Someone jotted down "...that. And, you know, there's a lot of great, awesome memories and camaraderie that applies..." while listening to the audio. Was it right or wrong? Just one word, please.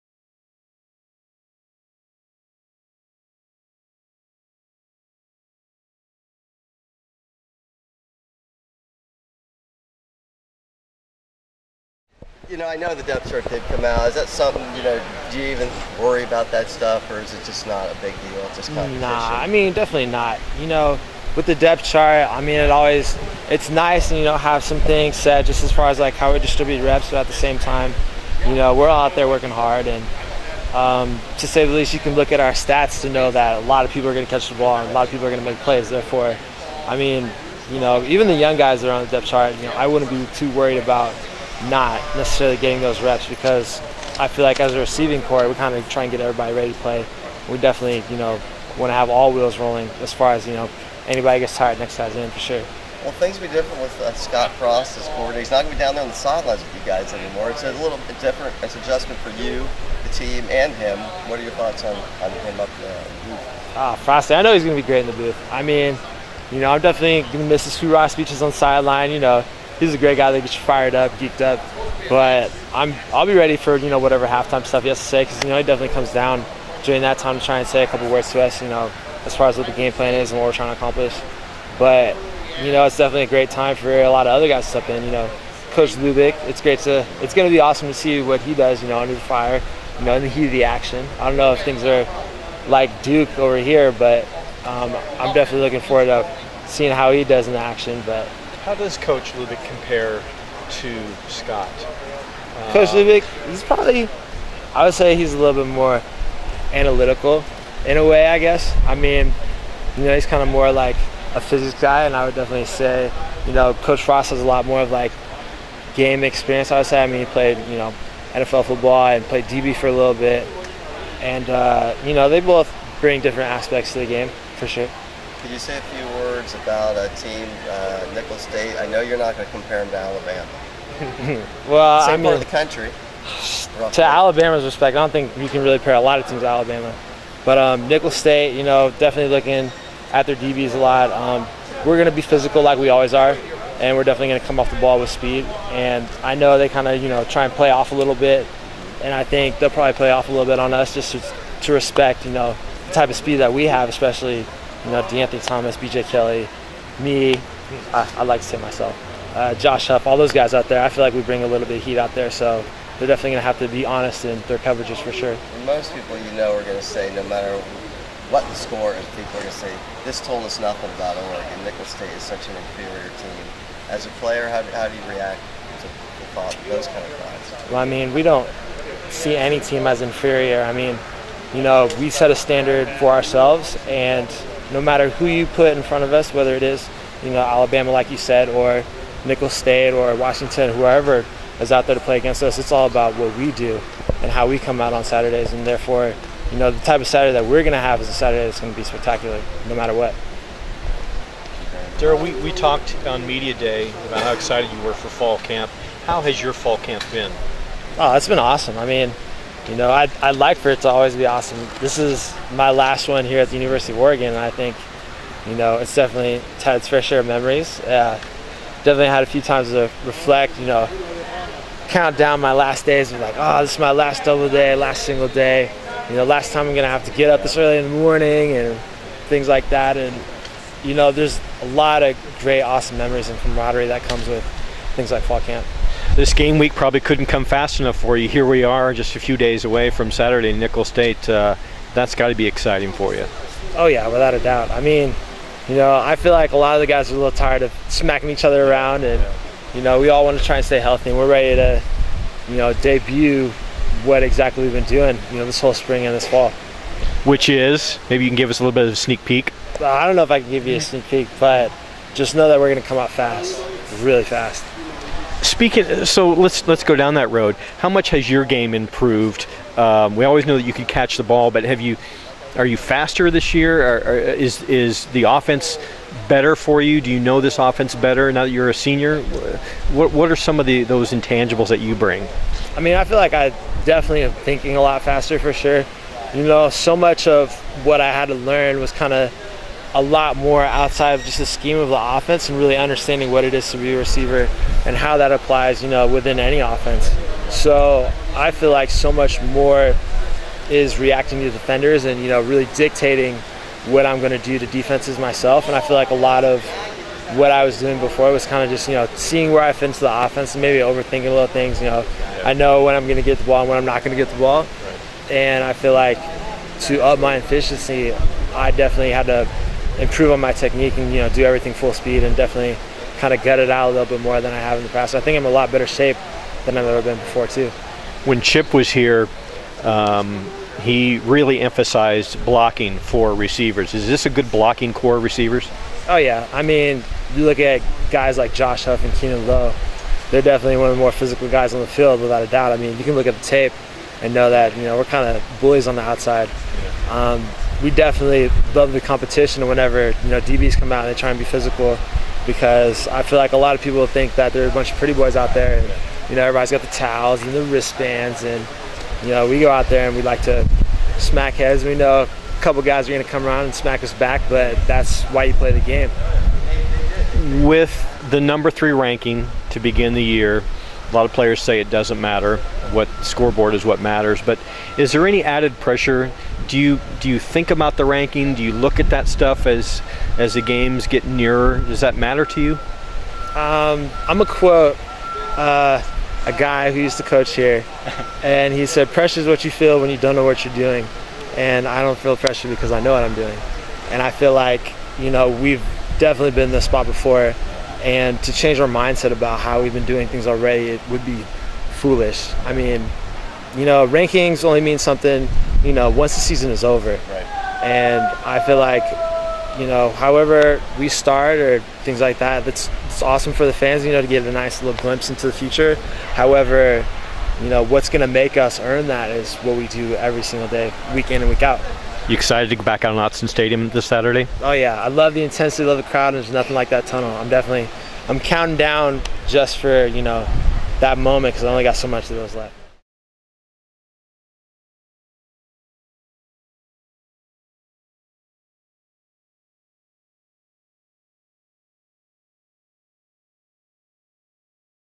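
wrong.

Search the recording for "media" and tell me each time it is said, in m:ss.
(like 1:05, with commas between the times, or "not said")
3:23.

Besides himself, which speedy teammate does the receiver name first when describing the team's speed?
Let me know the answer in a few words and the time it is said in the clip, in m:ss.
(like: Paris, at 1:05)
DeAnthony Thomas, at 2:35.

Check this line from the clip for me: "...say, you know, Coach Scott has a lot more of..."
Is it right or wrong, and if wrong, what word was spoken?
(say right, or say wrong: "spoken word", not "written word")
wrong: "Frost", not "Scott".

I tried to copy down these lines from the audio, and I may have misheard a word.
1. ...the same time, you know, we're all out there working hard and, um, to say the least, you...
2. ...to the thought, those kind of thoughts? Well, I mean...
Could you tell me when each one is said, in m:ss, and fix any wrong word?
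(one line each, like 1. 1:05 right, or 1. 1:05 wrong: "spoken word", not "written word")
1. 0:27 right
2. 2:55 right.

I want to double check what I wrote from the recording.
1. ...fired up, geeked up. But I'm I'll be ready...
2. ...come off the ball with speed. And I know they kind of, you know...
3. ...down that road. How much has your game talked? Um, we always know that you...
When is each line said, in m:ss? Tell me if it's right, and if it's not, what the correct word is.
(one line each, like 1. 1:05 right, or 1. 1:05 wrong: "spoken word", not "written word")
1. 1:10 right
2. 2:24 right
3. 4:26 wrong: "improved", not "talked".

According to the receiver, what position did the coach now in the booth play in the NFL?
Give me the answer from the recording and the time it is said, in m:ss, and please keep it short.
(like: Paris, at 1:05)
DB, at 1:59.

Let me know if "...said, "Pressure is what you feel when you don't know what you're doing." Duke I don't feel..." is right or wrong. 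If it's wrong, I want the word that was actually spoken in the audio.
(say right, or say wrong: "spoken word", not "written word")
wrong: "And", not "Duke".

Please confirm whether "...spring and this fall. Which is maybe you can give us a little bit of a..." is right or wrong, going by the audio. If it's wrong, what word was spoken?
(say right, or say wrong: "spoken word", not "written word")
right.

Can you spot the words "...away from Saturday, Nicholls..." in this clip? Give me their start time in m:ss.
3:59.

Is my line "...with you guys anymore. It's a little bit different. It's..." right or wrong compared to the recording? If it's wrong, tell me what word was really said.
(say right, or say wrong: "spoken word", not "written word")
right.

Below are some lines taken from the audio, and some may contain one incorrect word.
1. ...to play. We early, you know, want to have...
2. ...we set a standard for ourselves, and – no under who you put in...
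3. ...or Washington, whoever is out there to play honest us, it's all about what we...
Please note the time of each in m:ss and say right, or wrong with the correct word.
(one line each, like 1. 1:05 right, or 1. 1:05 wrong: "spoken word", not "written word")
1. 0:46 wrong: "definitely", not "early"
2. 3:01 wrong: "matter", not "under"
3. 3:09 wrong: "against", not "honest".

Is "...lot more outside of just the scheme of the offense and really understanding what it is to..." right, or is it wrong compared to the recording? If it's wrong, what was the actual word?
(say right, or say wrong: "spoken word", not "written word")
right.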